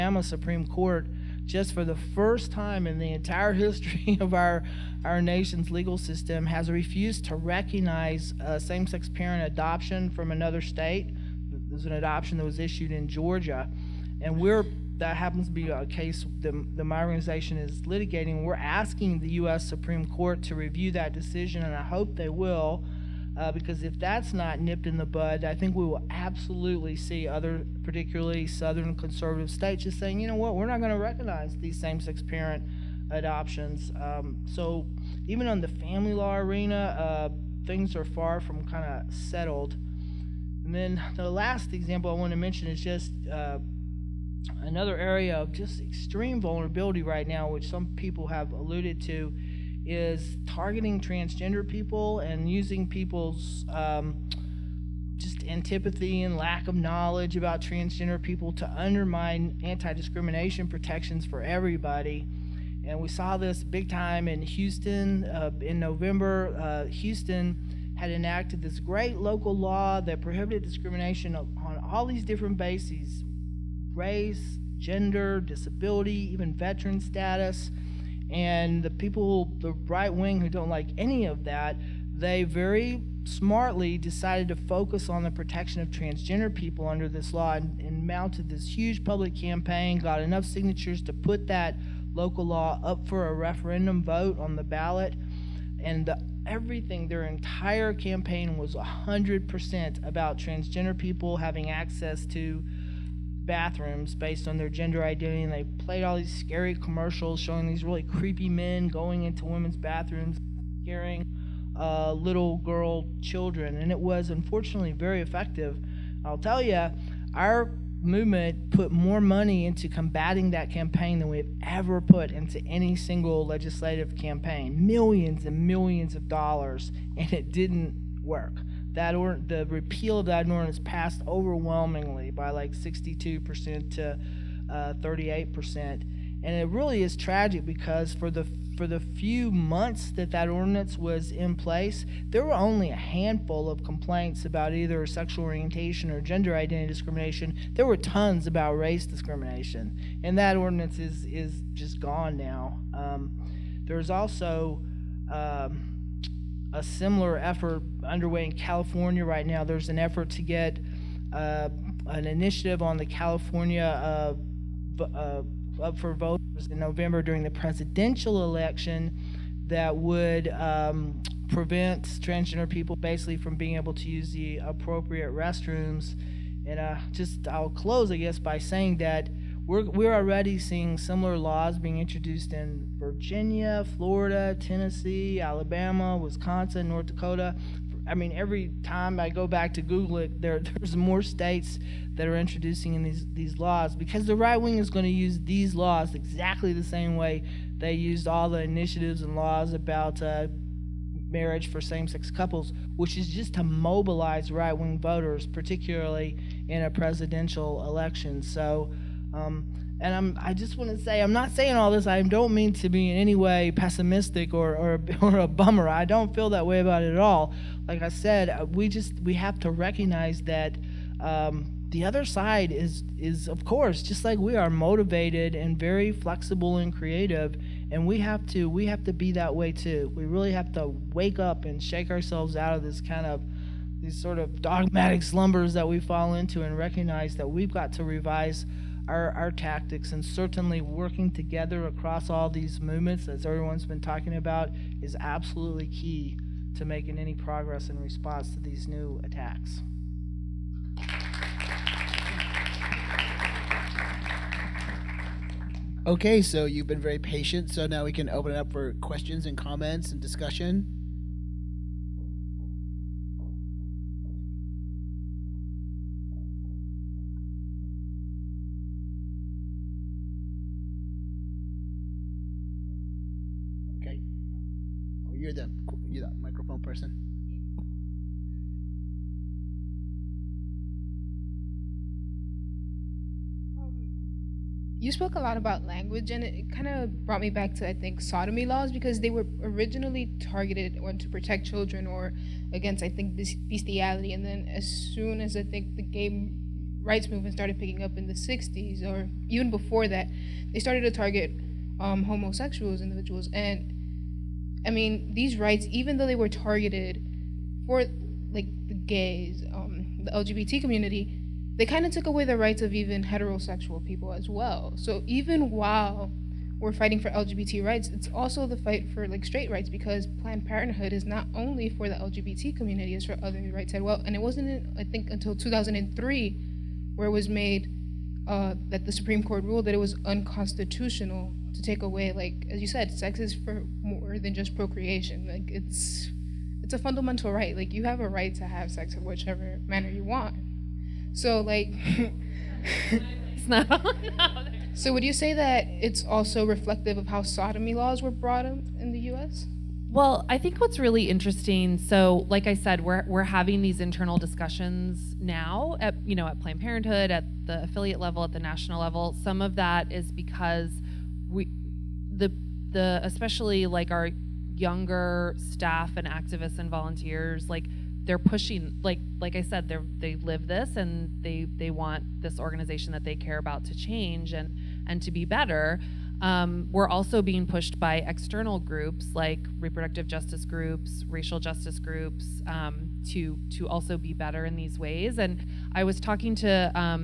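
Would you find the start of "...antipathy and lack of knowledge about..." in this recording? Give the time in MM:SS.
00:55.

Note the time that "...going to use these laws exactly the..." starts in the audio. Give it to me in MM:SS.
03:14.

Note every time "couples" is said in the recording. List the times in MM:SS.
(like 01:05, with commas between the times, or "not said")
03:22.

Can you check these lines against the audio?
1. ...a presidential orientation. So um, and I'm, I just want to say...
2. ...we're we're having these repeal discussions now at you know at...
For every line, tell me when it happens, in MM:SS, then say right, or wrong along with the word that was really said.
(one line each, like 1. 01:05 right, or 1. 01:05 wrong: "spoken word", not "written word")
1. 03:26 wrong: "election", not "orientation"
2. 05:53 wrong: "internal", not "repeal".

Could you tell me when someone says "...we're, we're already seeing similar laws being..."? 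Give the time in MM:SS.
02:59.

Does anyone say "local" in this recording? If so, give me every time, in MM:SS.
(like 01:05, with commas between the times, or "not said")
01:09, 01:32.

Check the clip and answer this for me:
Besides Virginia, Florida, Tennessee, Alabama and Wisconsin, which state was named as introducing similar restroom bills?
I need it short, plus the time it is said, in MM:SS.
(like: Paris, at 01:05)
North Dakota, at 03:06.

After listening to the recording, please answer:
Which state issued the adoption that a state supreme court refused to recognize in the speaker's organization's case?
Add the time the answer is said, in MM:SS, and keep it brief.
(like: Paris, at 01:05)
Georgia, at 00:13.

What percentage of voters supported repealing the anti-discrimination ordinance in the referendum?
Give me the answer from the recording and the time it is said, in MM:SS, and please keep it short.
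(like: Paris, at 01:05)
62%, at 02:12.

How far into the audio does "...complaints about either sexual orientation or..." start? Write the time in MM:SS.
02:23.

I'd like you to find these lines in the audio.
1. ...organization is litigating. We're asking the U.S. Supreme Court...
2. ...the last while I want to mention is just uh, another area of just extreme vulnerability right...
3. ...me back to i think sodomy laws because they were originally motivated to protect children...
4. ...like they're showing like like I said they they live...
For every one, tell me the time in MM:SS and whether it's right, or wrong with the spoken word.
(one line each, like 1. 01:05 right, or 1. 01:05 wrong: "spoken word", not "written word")
1. 00:17 right
2. 00:41 wrong: "example", not "while"
3. 04:47 wrong: "targeted", not "motivated"
4. 06:07 wrong: "pushing", not "showing".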